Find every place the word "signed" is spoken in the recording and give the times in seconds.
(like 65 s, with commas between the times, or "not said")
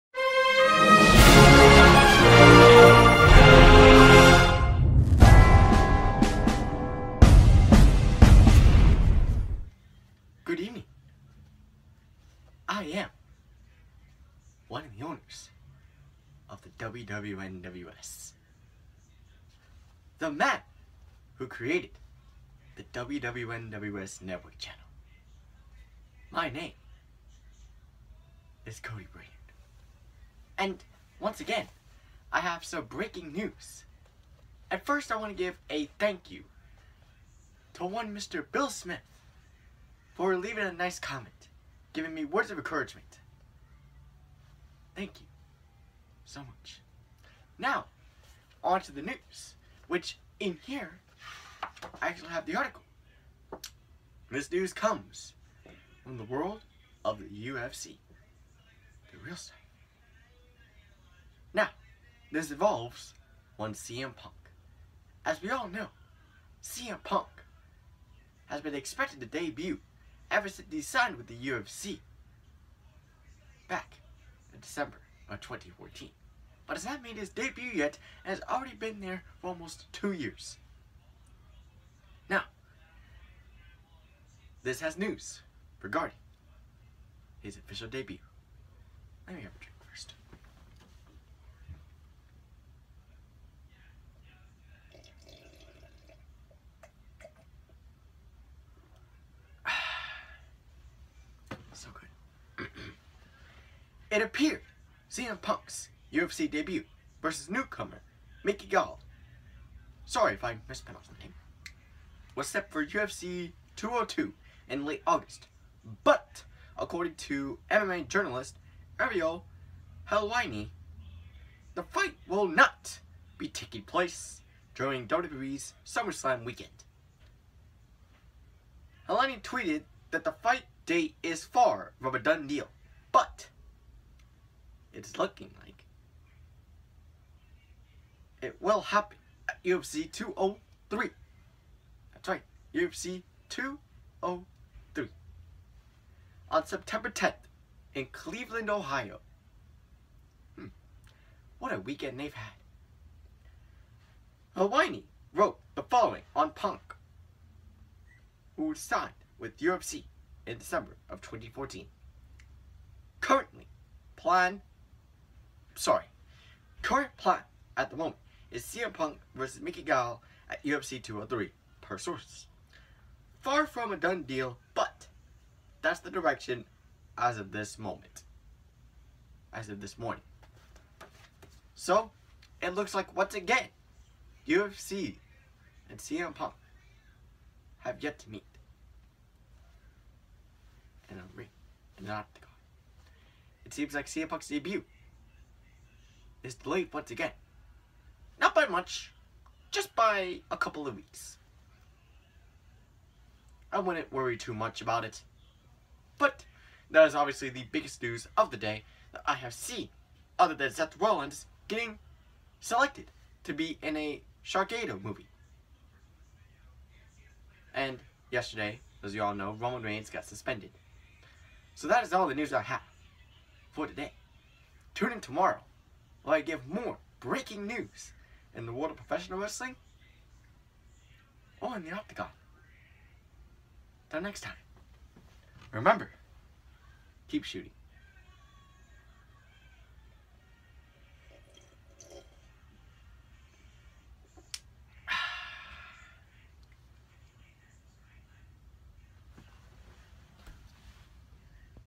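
70 s, 158 s.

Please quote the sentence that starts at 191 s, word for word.
And I'm re- and not the It seems like CM Punk's debut is delayed once again.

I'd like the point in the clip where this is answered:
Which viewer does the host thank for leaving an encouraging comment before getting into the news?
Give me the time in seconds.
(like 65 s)
38 s.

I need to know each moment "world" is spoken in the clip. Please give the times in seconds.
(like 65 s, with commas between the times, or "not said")
56 s, 228 s.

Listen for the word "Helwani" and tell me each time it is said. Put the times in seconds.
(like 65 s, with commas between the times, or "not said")
120 s, 129 s, 154 s.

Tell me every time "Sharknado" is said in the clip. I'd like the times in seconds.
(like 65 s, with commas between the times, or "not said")
214 s.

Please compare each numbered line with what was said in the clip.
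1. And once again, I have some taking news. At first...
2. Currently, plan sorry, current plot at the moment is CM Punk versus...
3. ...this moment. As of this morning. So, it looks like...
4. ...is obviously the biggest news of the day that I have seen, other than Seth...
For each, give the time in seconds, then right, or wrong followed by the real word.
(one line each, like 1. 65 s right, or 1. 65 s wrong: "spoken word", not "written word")
1. 30 s wrong: "breaking", not "taking"
2. 163 s right
3. 177 s right
4. 207 s right.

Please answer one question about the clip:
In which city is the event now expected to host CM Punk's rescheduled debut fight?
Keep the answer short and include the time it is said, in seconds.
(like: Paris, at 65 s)
Cleveland, Ohio, at 148 s.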